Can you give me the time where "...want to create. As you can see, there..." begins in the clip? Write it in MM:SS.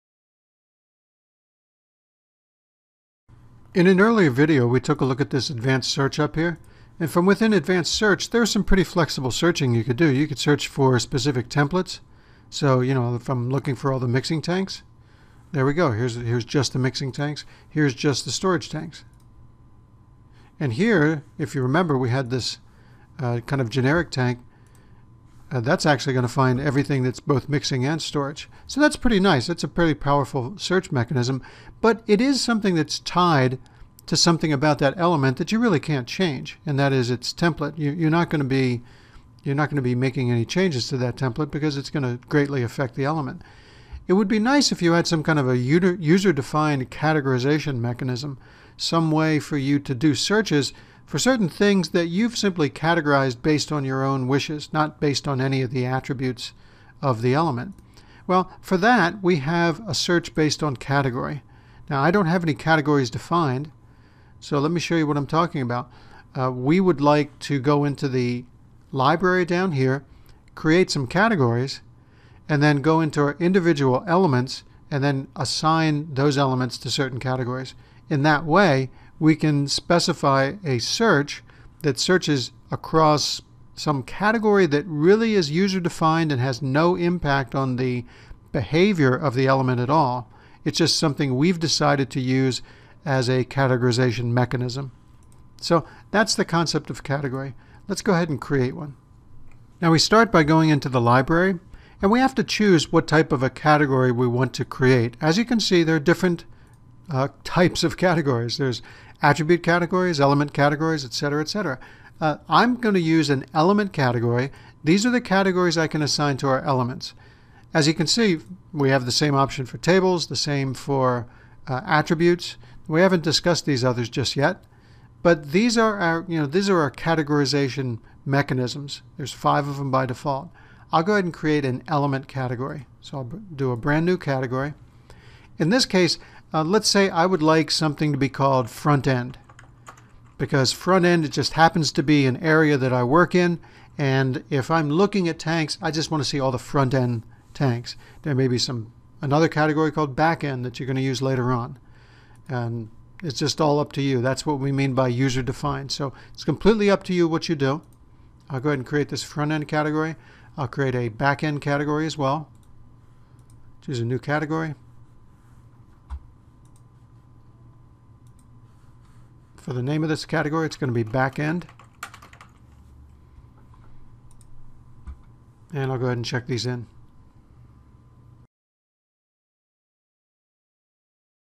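01:44.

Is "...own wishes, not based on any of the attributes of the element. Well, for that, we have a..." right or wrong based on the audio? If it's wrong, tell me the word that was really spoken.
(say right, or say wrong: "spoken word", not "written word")
right.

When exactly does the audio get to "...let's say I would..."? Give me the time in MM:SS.
02:16.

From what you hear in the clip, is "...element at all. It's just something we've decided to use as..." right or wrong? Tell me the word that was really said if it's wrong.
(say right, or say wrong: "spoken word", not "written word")
right.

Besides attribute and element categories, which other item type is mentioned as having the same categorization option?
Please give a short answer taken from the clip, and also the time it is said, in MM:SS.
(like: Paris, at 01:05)
tables, at 01:59.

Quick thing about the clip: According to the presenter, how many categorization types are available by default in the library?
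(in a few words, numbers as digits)
5.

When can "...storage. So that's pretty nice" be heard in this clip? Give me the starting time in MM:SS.
00:28.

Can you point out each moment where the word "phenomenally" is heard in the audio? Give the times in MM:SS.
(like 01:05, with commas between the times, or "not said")
not said.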